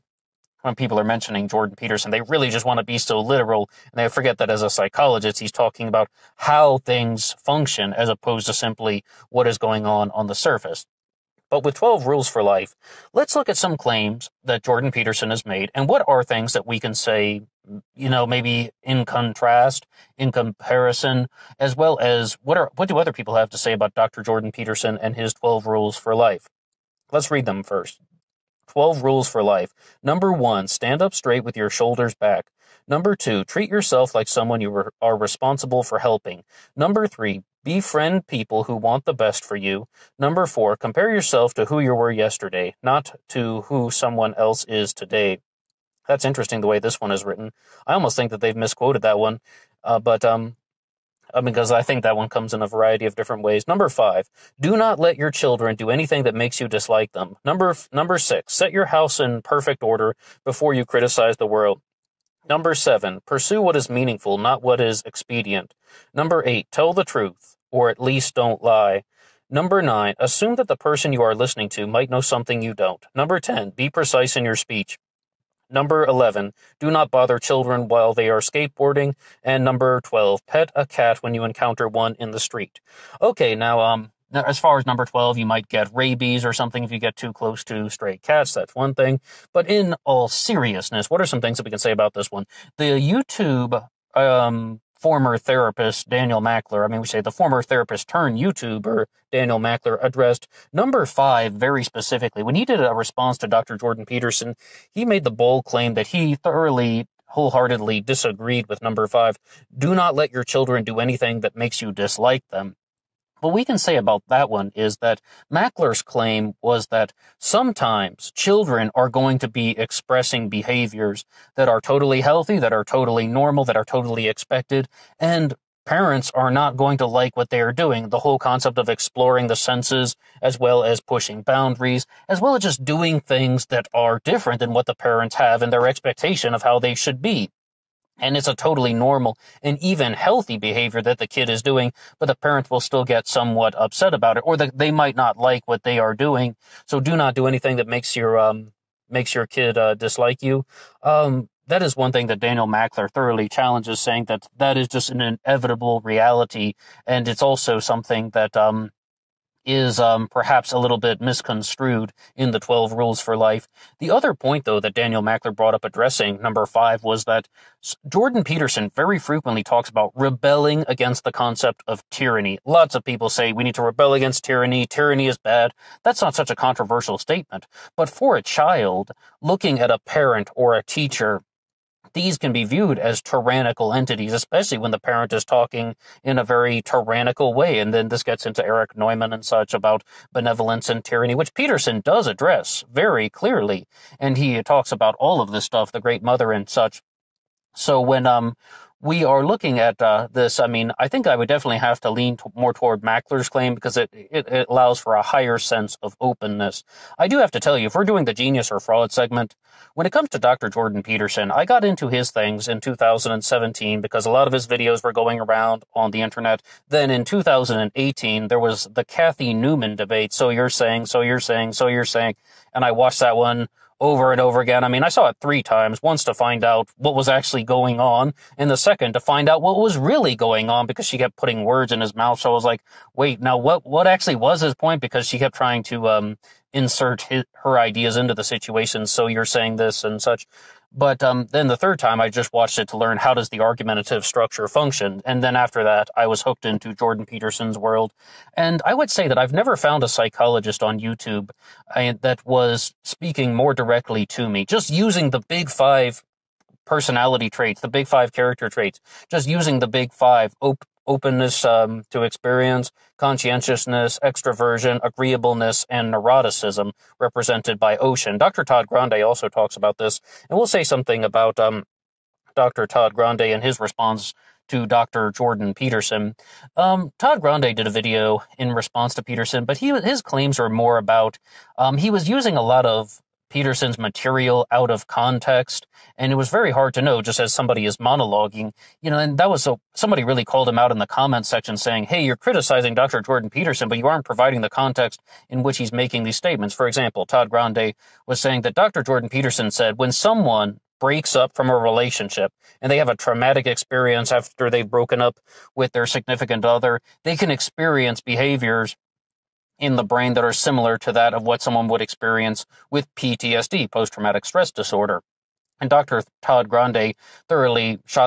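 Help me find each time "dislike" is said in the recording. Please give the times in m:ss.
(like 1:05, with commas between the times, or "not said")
0:56, 1:51, 2:29.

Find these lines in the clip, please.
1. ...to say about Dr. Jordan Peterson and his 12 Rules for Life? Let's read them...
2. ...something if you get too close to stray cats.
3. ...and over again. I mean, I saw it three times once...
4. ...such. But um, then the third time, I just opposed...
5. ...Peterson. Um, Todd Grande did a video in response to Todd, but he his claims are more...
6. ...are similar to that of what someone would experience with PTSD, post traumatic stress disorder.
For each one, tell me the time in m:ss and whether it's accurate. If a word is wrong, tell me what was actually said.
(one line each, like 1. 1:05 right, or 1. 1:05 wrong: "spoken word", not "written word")
1. 0:23 right
2. 1:26 right
3. 3:44 right
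4. 4:00 wrong: "watched", not "opposed"
5. 4:35 wrong: "Peterson", not "Todd"
6. 5:10 right.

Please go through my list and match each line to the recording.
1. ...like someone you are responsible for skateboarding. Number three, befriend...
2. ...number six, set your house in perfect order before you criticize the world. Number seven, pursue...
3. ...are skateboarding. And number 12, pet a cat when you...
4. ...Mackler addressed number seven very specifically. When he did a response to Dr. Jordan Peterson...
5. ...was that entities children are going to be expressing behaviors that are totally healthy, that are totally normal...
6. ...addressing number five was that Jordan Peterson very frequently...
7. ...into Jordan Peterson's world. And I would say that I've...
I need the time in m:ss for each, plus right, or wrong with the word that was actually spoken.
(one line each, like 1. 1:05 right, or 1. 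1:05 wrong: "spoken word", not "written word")
1. 0:34 wrong: "helping", not "skateboarding"
2. 0:57 right
3. 1:18 right
4. 1:39 wrong: "five", not "seven"
5. 1:56 wrong: "sometimes", not "entities"
6. 2:45 right
7. 4:06 right.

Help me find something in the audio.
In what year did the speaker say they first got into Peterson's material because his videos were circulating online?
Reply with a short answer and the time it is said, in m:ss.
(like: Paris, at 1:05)
2017, at 3:32.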